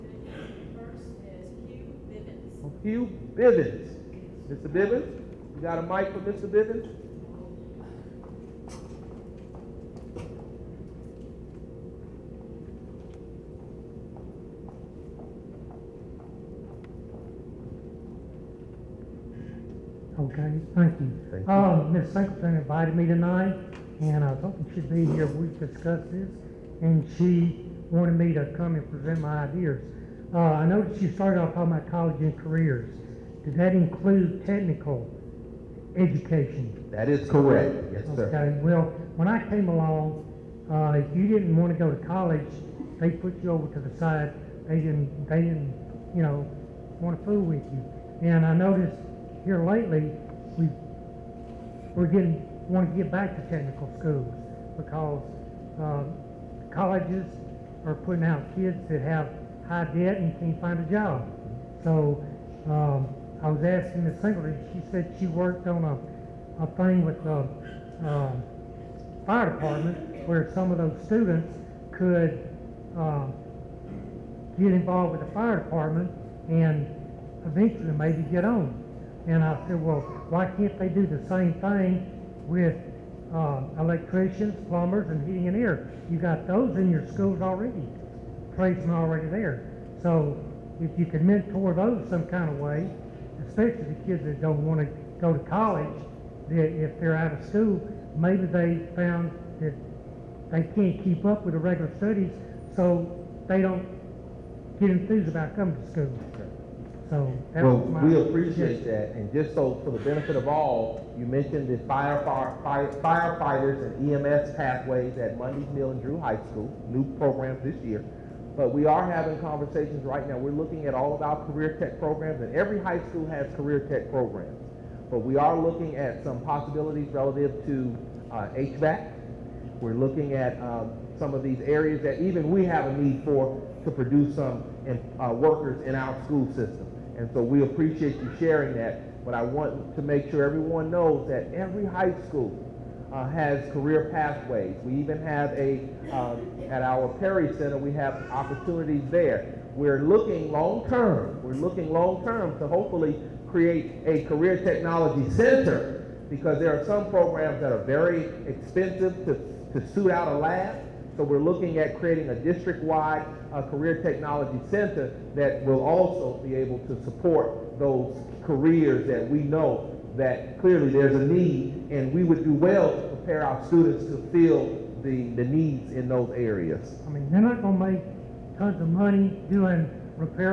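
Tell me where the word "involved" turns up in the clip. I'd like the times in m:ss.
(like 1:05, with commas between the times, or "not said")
1:14.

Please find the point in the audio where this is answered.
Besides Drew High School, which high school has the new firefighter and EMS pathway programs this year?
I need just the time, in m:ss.
1:55.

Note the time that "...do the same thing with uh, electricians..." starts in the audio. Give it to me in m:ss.
1:20.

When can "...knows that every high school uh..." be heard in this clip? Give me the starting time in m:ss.
2:20.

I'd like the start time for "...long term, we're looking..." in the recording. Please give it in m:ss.
2:30.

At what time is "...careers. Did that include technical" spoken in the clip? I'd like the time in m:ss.
0:32.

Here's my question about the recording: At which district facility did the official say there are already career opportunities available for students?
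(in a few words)
Perry Center.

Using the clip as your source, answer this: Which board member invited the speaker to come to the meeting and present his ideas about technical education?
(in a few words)
Ms. Singleton.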